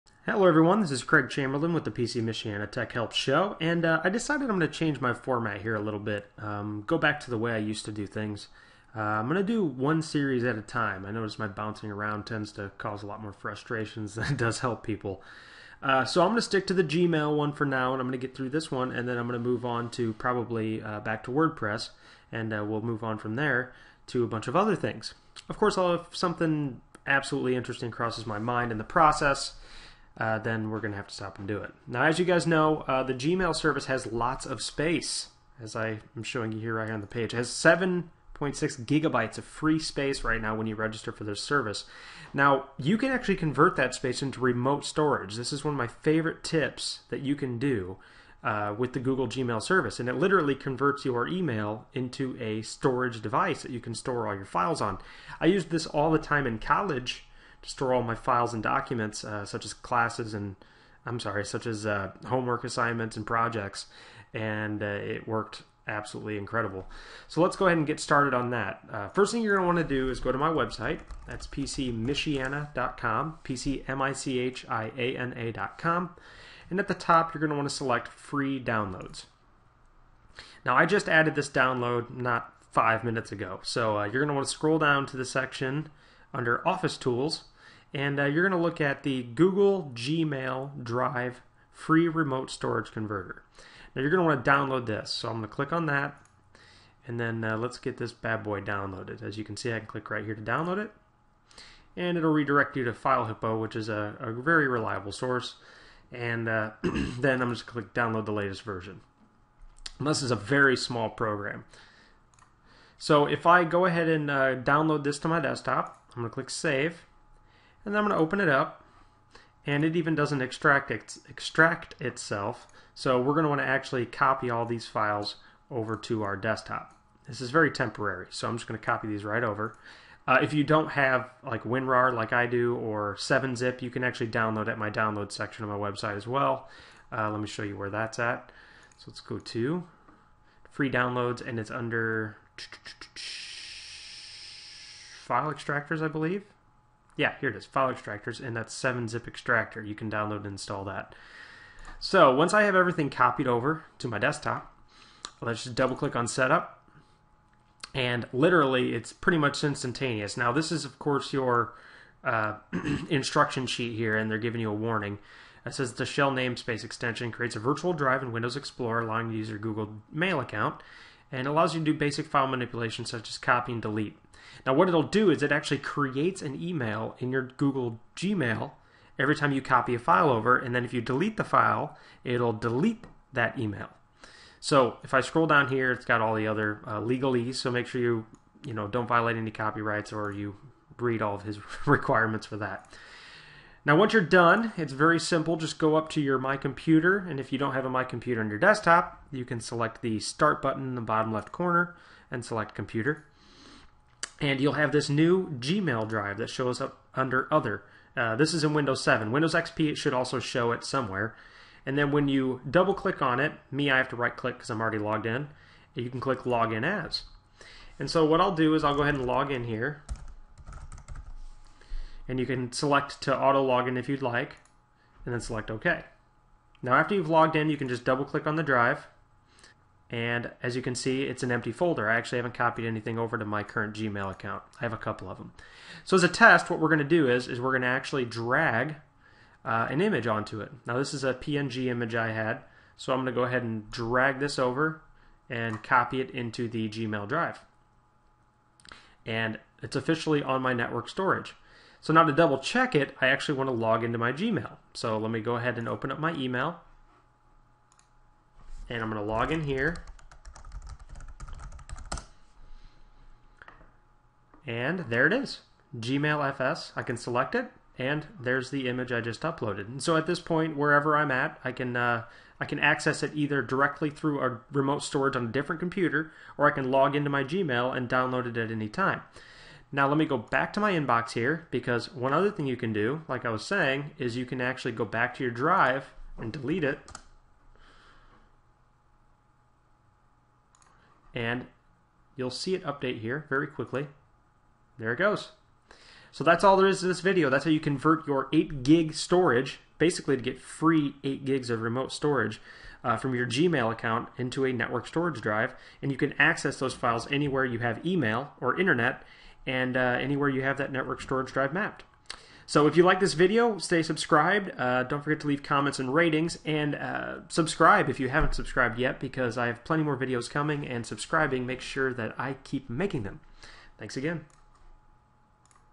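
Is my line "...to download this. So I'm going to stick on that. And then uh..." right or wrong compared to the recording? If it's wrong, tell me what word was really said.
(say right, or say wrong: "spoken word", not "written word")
wrong: "click", not "stick".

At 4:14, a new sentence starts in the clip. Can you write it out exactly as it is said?
So let me go ahead and open up my email.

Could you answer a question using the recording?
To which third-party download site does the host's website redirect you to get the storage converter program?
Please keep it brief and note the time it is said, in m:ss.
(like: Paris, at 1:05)
FileHippo, at 1:42.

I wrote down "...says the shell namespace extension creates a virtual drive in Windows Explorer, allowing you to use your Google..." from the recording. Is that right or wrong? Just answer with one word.
right.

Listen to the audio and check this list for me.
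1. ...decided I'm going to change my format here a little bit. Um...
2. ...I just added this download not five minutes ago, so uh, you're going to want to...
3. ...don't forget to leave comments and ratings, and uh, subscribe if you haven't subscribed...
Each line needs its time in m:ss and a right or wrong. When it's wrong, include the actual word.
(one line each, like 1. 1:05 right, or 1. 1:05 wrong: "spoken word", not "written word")
1. 0:04 right
2. 1:20 right
3. 5:15 right.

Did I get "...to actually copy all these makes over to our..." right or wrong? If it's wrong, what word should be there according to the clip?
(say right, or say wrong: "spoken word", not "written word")
wrong: "files", not "makes".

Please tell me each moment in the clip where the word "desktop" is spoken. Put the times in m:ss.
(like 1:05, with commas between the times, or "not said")
1:55, 2:06, 2:34, 3:18.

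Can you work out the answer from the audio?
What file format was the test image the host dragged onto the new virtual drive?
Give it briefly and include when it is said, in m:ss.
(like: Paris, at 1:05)
PNG, at 4:01.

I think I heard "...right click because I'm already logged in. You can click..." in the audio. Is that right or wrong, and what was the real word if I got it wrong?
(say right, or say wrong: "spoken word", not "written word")
right.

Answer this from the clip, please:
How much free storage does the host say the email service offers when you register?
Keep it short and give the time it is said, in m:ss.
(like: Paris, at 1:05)
7.6 gigabytes, at 0:37.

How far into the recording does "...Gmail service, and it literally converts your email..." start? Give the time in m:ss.
0:49.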